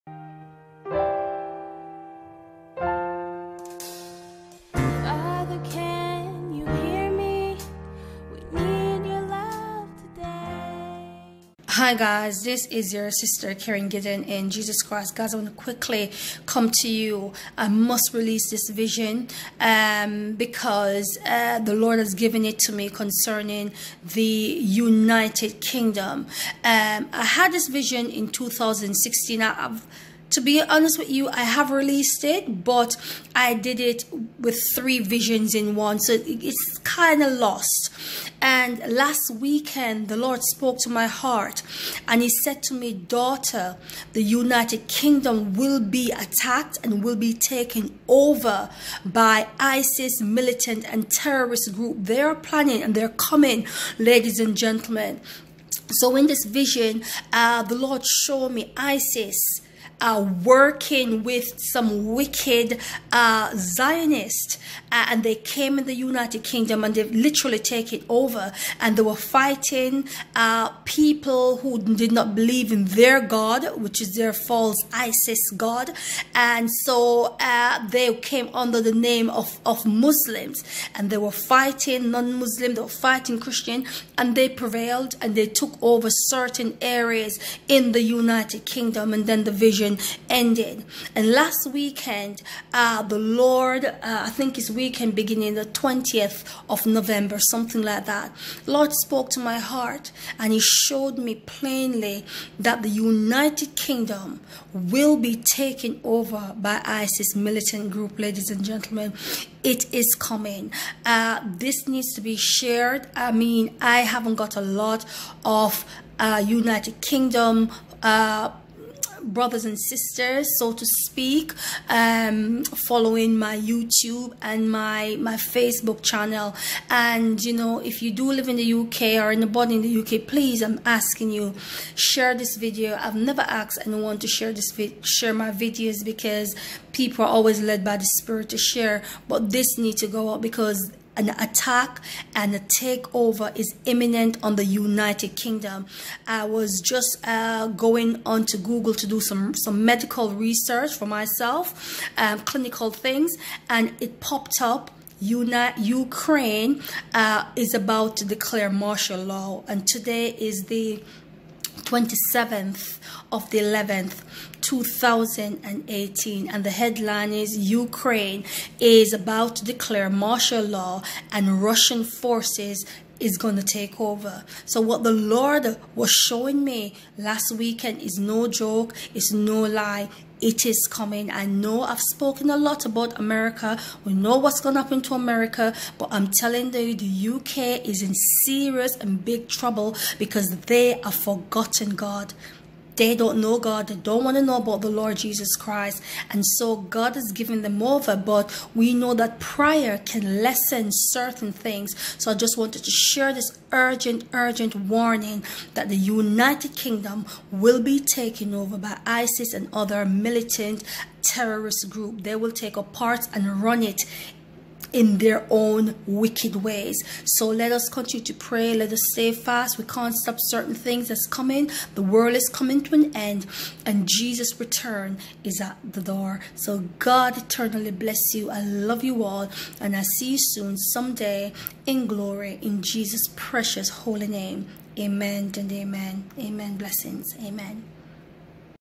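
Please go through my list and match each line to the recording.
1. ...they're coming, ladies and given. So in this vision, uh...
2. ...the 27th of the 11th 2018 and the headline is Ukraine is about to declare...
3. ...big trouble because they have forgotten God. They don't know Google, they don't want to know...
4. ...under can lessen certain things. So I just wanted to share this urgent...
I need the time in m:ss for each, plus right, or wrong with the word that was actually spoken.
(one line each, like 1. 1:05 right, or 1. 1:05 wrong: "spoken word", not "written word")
1. 0:52 wrong: "gentlemen", not "given"
2. 2:40 right
3. 3:09 wrong: "God", not "Google"
4. 3:19 wrong: "prayer", not "under".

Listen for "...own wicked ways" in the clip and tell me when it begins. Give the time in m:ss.
3:35.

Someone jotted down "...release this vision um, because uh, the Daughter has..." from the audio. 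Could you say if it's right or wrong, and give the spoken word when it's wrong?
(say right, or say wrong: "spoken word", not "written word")
wrong: "Lord", not "Daughter".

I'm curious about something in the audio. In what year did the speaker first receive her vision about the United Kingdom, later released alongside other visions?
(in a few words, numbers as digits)
2016.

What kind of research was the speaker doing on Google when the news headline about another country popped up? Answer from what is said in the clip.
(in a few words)
medical research.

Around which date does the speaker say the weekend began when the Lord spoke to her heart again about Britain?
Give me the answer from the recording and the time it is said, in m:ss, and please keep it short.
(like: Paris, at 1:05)
20th of November, at 1:35.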